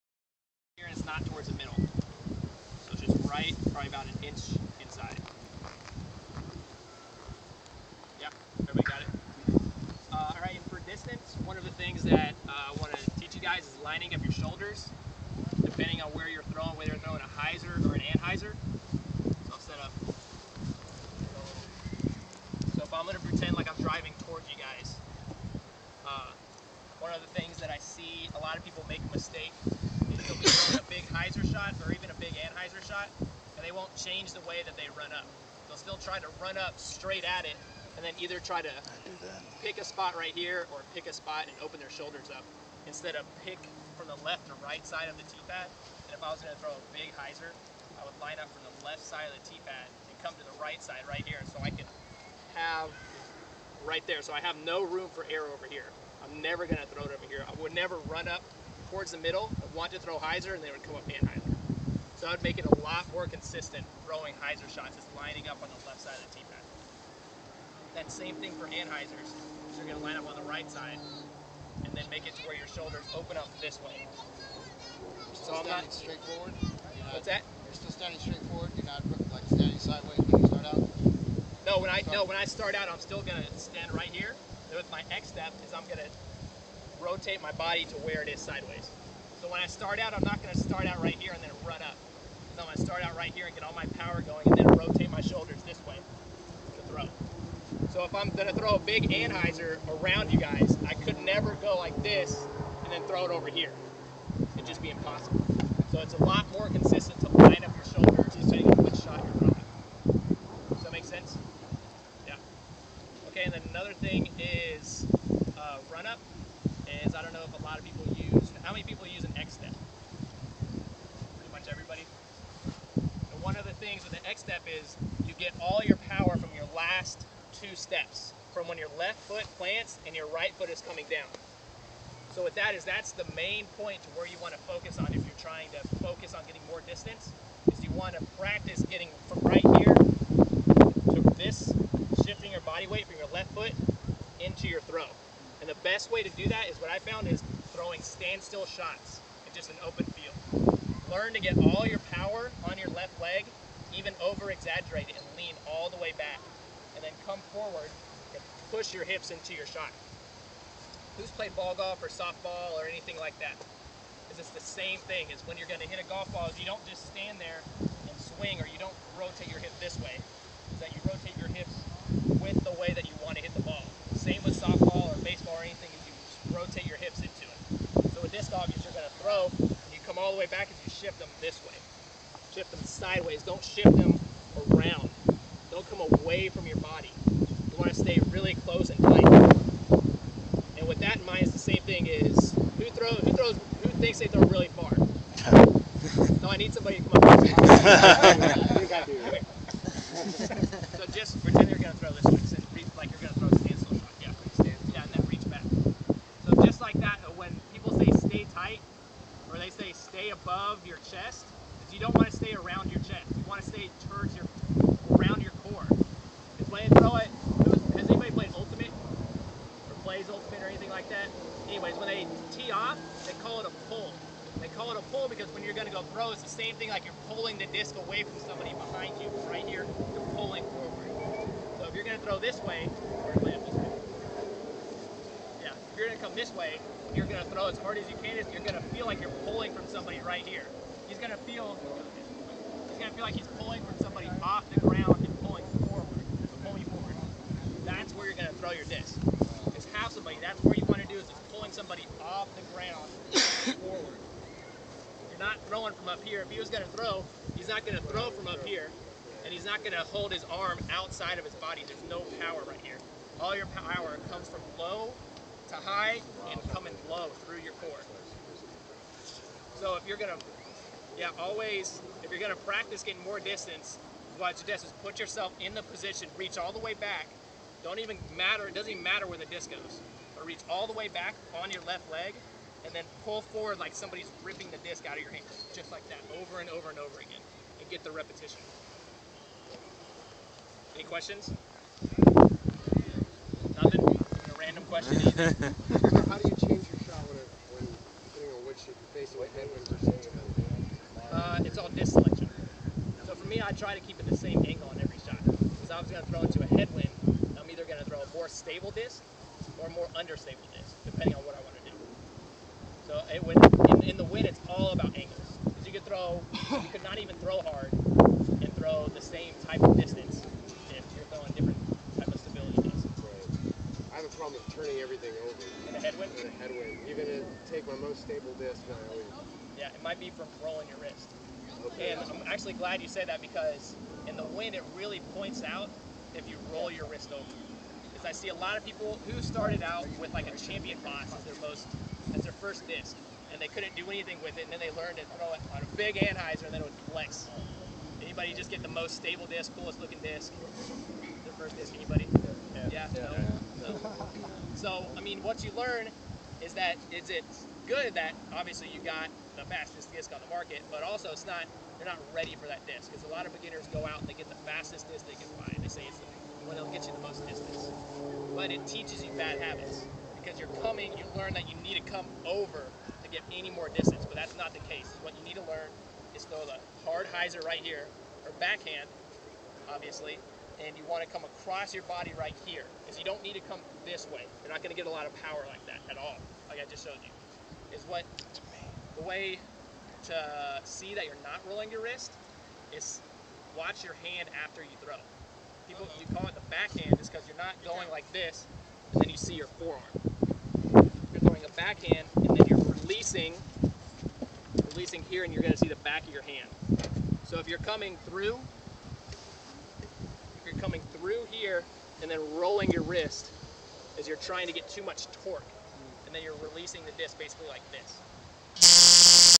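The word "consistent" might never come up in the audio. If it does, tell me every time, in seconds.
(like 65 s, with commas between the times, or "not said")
63 s, 106 s.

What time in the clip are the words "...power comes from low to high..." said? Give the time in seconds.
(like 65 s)
263 s.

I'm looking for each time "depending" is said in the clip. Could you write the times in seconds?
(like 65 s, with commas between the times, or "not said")
15 s, 108 s, 298 s, 311 s.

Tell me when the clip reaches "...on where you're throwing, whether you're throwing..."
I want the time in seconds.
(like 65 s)
16 s.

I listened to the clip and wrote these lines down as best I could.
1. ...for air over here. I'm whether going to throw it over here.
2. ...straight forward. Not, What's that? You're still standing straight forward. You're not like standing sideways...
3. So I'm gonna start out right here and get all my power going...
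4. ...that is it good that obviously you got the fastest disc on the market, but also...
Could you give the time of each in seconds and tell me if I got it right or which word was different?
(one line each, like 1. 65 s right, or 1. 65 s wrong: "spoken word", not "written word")
1. 55 s wrong: "never", not "whether"
2. 75 s right
3. 92 s right
4. 356 s right.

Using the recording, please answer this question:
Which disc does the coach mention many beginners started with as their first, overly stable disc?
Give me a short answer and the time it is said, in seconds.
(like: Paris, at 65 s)
Champion Boss, at 340 s.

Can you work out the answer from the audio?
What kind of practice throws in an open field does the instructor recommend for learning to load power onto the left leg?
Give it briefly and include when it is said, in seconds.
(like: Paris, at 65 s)
standstill shots, at 148 s.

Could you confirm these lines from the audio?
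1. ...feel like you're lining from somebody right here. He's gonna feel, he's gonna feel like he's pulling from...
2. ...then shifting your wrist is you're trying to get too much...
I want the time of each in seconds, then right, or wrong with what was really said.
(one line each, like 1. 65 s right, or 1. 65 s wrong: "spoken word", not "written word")
1. 238 s wrong: "pulling", not "lining"
2. 412 s wrong: "rolling", not "shifting".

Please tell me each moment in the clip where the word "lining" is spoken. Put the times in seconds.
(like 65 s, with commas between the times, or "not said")
13 s, 65 s.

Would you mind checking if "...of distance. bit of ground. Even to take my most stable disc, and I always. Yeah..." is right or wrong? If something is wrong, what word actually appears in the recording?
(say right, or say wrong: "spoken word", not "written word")
wrong: "headwind", not "ground".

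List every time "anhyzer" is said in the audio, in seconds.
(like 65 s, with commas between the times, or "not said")
18 s, 32 s, 61 s, 68 s, 99 s, 346 s.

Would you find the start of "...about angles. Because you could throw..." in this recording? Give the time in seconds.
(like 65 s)
314 s.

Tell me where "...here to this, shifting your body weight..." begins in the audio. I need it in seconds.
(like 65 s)
139 s.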